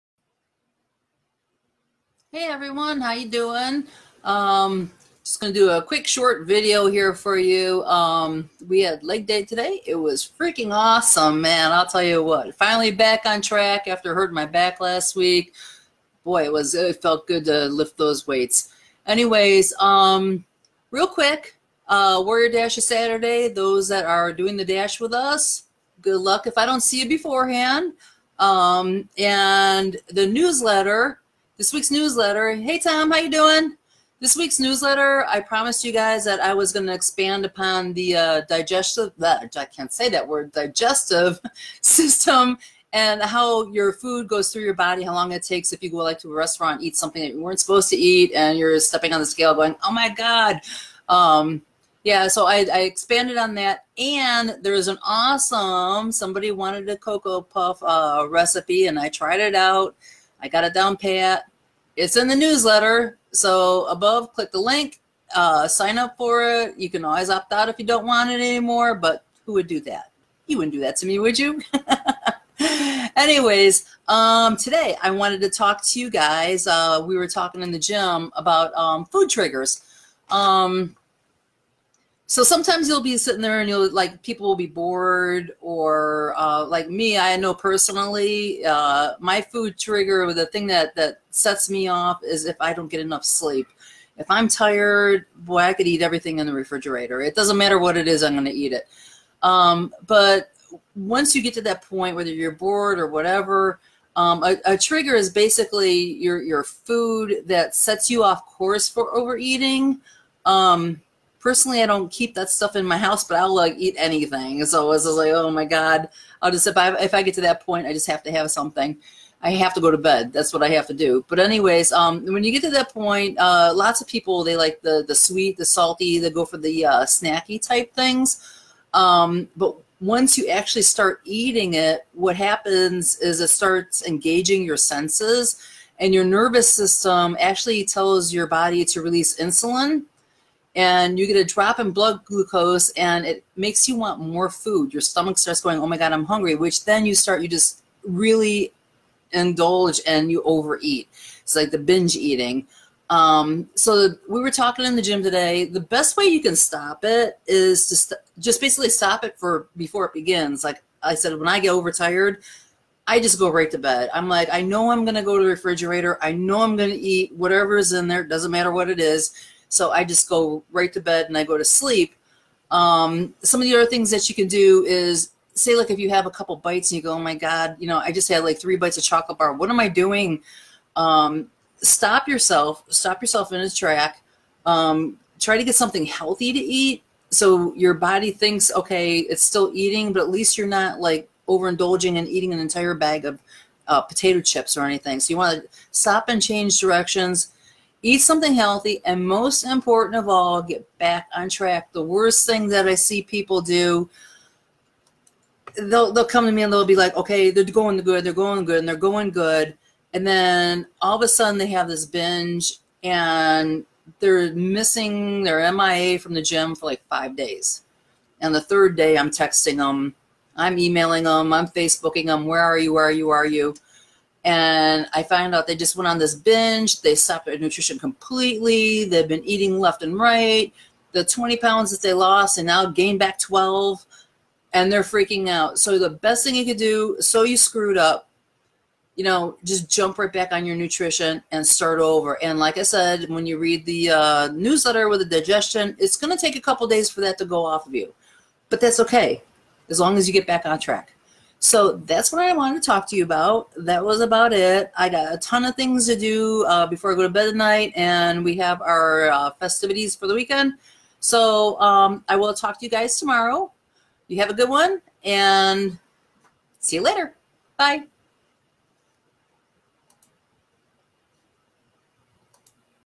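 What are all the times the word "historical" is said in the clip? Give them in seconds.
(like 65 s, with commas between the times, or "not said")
not said.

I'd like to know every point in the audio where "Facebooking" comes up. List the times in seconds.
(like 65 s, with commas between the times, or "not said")
221 s.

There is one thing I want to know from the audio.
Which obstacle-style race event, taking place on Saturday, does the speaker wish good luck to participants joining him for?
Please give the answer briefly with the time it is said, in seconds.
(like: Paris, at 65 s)
Warrior Dash, at 22 s.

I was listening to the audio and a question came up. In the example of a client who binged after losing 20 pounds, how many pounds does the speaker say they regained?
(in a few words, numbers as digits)
12.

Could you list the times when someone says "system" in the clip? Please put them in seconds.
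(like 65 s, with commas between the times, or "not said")
41 s, 136 s.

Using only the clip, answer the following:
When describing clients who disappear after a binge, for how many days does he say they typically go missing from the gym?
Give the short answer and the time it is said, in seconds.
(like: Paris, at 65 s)
5, at 217 s.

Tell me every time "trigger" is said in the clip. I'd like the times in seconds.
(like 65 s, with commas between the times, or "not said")
79 s, 89 s, 104 s.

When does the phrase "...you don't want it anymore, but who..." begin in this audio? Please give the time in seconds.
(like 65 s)
67 s.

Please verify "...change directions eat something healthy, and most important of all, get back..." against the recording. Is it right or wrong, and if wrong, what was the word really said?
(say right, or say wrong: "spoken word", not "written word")
right.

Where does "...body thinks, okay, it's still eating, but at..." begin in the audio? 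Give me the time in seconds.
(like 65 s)
187 s.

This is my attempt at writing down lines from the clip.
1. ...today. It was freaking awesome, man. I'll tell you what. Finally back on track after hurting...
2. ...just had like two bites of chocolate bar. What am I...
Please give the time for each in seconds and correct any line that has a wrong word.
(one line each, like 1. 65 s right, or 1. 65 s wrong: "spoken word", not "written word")
1. 9 s right
2. 178 s wrong: "three", not "two".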